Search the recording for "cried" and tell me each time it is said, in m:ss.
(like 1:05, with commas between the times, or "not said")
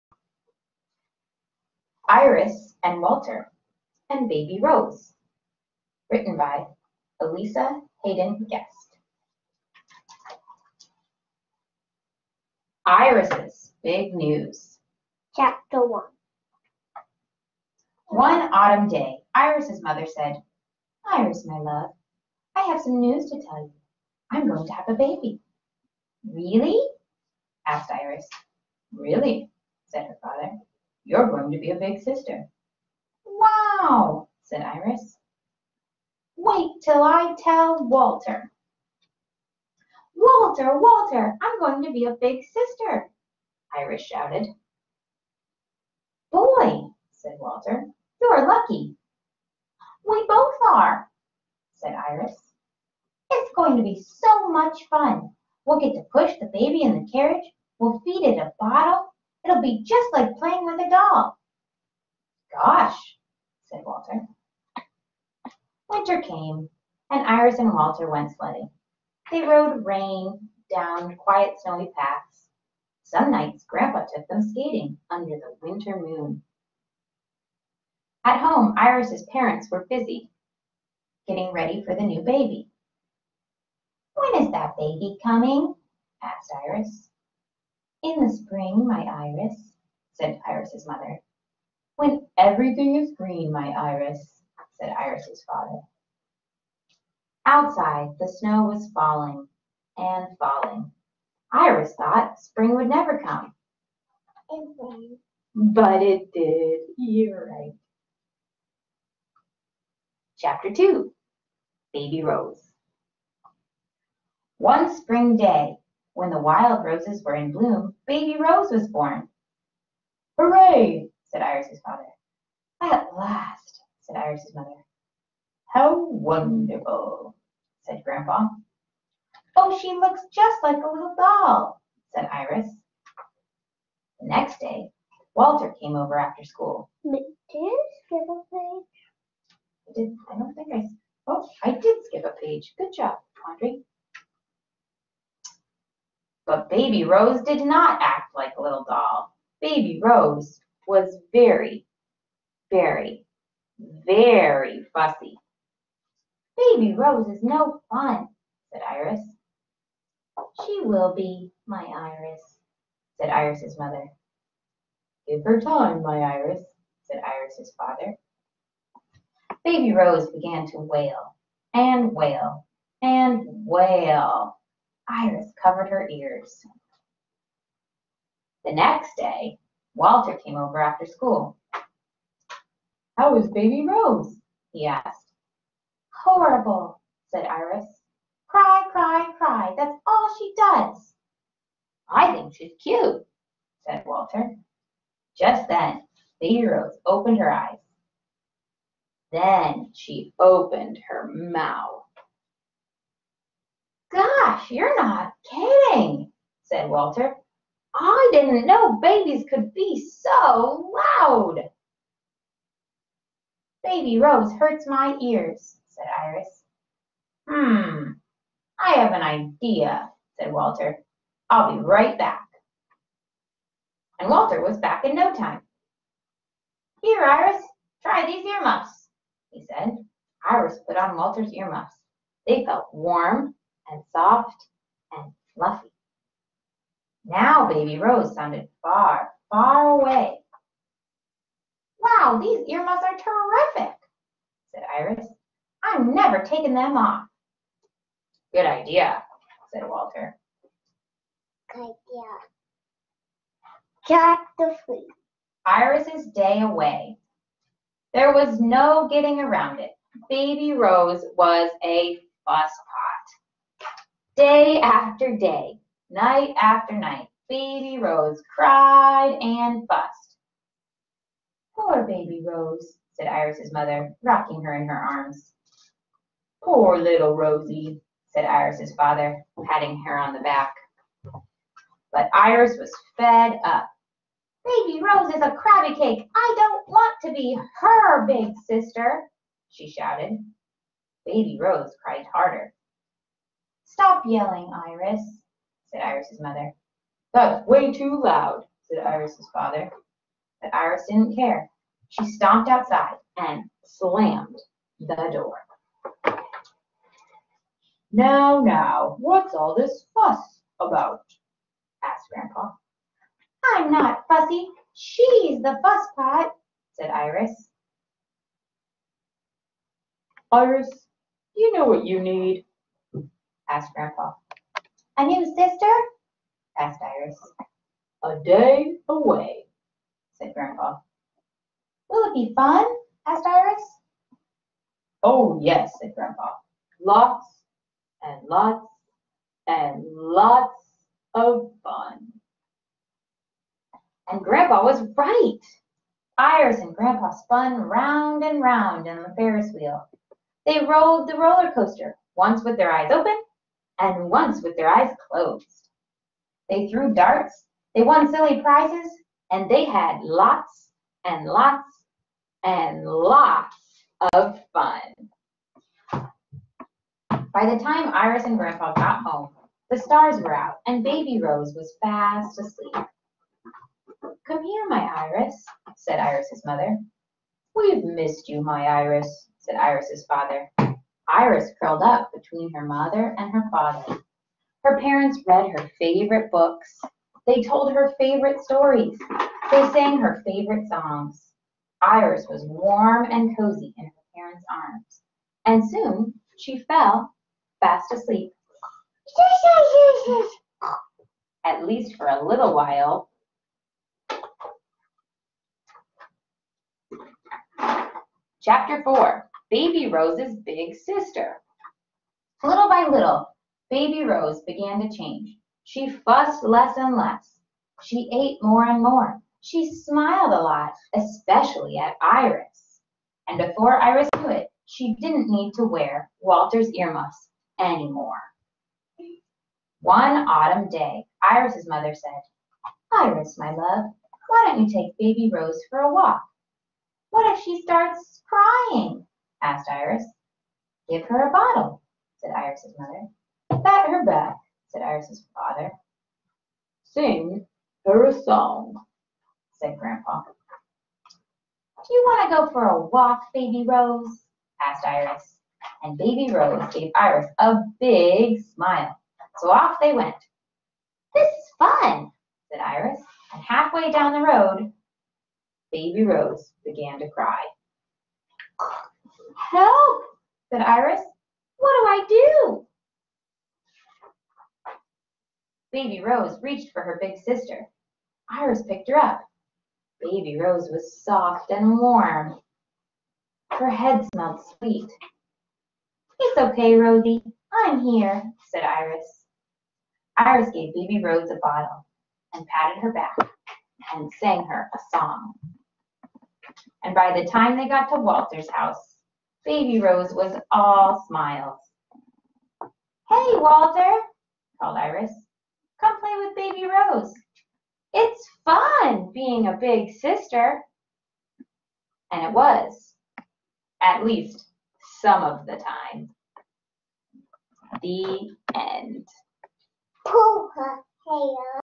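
4:28, 4:52.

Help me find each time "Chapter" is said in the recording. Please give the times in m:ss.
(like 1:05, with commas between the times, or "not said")
0:15, 1:50, 6:48.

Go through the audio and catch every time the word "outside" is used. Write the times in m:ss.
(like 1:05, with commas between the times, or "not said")
1:37, 5:02.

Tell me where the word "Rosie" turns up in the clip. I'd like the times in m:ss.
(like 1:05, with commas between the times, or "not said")
4:37, 8:06.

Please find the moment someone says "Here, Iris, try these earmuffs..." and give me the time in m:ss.
3:47.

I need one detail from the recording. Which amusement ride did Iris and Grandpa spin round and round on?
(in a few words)
Ferris wheel.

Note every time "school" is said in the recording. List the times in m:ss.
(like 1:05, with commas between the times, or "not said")
2:16, 3:01.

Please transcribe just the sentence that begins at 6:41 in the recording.
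At least for a little while.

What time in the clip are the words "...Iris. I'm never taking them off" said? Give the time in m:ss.
4:04.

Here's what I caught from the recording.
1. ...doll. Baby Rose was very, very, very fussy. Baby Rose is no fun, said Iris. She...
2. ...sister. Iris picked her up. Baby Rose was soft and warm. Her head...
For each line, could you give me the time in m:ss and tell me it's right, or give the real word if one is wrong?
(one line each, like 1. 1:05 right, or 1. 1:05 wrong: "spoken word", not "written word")
1. 2:28 right
2. 7:57 right.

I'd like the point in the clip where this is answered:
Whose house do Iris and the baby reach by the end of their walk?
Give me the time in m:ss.
8:18.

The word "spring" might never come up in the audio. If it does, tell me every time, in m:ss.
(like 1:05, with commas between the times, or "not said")
1:28, 1:42, 1:54.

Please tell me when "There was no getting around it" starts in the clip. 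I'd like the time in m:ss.
4:18.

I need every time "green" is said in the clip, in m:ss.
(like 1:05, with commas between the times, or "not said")
1:33.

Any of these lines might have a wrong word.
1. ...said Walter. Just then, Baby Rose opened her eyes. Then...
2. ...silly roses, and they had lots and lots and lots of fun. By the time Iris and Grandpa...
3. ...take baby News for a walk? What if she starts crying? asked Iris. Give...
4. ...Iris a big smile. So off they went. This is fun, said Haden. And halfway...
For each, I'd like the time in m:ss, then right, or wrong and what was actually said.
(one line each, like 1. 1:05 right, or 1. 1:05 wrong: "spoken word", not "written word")
1. 3:13 right
2. 5:58 wrong: "prizes", not "roses"
3. 7:14 wrong: "Rose", not "News"
4. 7:37 wrong: "Iris", not "Haden".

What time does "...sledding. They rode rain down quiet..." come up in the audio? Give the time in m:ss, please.
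1:08.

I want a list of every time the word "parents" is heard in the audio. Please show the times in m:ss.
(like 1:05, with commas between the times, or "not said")
1:19, 6:24, 6:34.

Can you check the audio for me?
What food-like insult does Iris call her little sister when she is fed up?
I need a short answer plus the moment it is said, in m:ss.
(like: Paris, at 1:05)
Crabby cake, at 4:45.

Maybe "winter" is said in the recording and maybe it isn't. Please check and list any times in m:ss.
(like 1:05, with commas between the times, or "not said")
1:05, 1:15.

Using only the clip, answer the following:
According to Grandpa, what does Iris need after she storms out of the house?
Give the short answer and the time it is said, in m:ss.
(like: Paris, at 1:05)
A day away, at 5:28.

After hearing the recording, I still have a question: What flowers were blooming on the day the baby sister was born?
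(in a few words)
Wild roses.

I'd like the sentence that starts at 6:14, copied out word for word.
Come here, my Iris, said Iris's mother.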